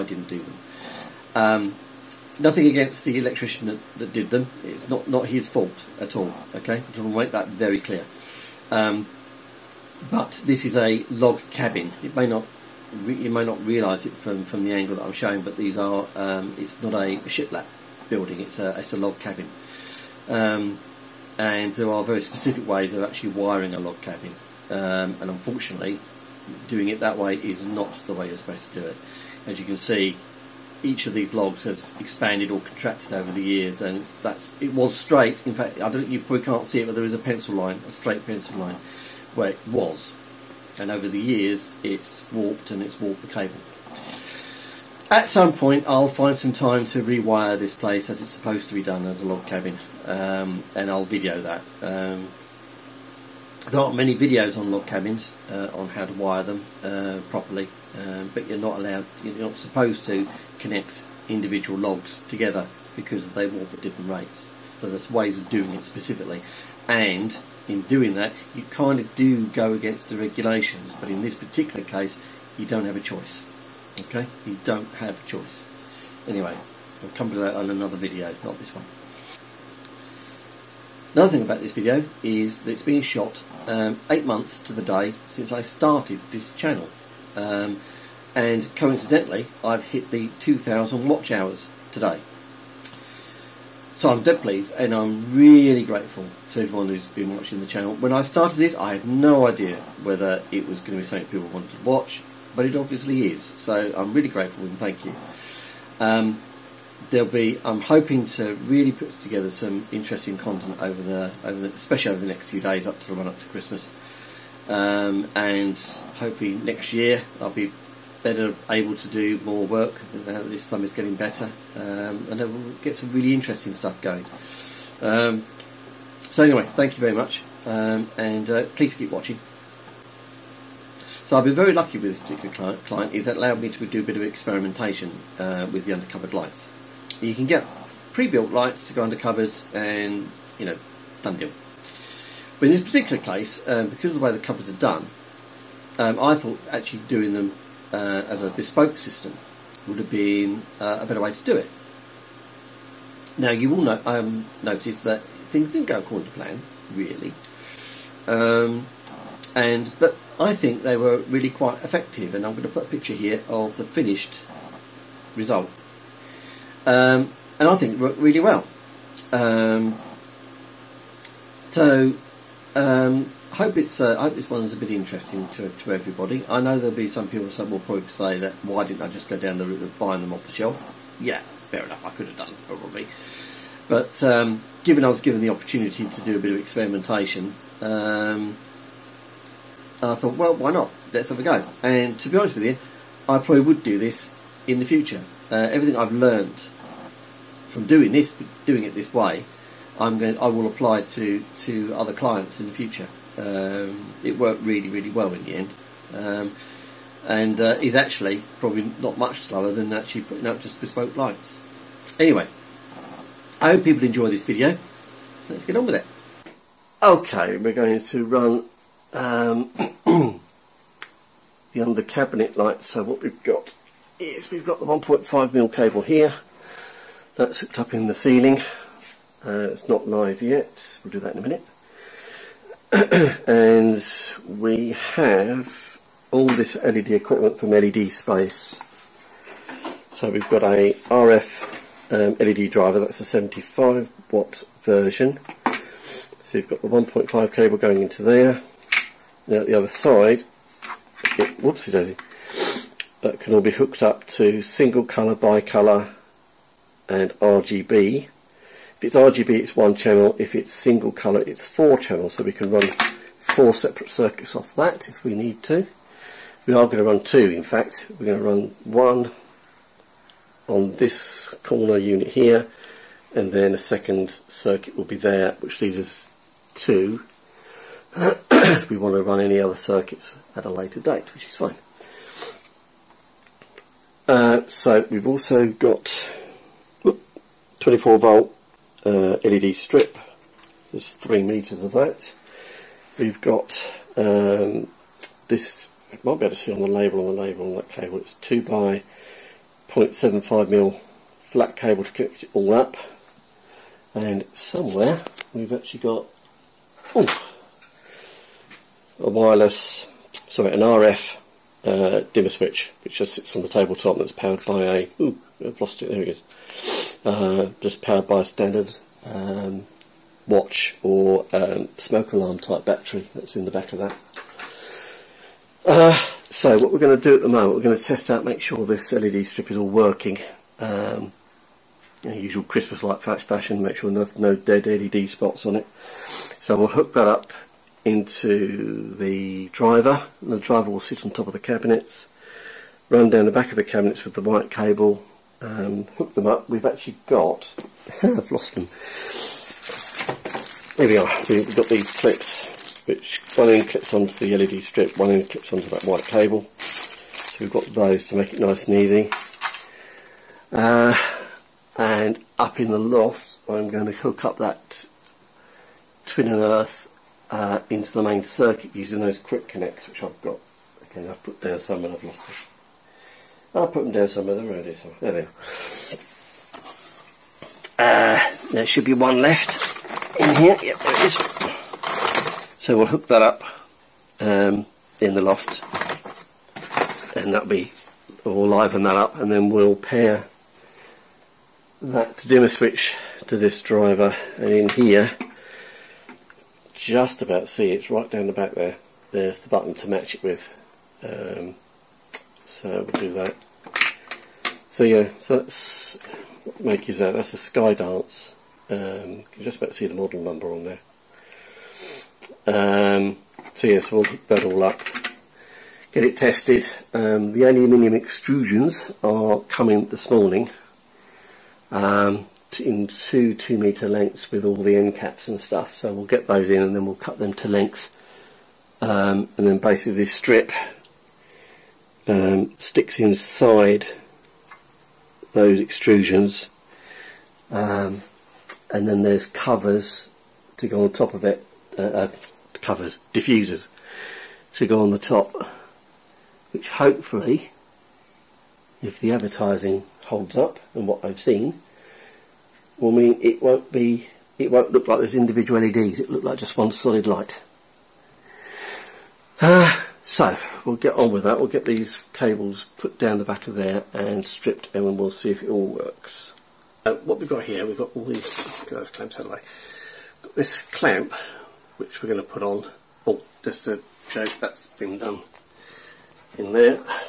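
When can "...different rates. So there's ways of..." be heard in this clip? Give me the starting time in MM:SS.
01:03.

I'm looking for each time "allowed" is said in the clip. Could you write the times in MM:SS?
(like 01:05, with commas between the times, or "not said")
00:58, 02:13.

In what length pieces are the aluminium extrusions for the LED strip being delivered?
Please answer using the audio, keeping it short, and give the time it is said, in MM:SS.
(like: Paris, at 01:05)
2 metres, at 07:03.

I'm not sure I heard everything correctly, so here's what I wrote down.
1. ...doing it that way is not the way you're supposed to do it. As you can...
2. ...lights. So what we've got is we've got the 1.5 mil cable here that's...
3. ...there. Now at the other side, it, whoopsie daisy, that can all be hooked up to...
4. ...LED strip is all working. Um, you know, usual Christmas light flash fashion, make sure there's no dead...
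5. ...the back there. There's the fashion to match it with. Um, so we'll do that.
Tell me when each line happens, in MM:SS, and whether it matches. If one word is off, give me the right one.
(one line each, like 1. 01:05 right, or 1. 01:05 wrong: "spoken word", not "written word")
1. 00:26 right
2. 03:42 right
3. 04:08 right
4. 05:29 right
5. 06:38 wrong: "button", not "fashion".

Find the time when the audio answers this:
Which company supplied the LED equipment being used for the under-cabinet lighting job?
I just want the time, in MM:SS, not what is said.
03:57.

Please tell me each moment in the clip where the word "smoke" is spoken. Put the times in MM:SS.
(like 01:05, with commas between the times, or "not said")
05:21.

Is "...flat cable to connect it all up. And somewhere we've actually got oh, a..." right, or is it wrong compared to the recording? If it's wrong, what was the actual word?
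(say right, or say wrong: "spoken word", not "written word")
right.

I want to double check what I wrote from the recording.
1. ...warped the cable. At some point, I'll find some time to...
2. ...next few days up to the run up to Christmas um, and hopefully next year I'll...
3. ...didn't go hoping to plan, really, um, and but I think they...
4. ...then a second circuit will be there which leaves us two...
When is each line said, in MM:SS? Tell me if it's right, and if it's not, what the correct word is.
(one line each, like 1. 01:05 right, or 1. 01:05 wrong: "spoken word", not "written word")
1. 00:42 right
2. 01:52 right
3. 02:35 wrong: "according", not "hoping"
4. 04:33 right.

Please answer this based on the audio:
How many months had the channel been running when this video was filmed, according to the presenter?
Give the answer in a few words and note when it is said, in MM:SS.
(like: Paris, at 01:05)
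8, at 01:24.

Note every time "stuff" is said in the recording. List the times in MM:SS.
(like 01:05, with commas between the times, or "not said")
02:03, 07:05.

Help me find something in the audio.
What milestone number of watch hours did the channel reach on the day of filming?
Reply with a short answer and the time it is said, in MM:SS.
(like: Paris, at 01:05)
2,000, at 01:30.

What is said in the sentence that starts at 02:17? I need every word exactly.
You can get pre-built lights to go under cupboards, and you know, done deal.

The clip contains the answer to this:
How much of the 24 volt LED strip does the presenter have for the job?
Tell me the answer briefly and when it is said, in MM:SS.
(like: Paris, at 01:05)
3 meters, at 04:51.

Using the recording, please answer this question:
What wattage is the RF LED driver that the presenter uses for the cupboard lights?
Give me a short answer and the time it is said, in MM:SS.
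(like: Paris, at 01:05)
75 watt, at 04:03.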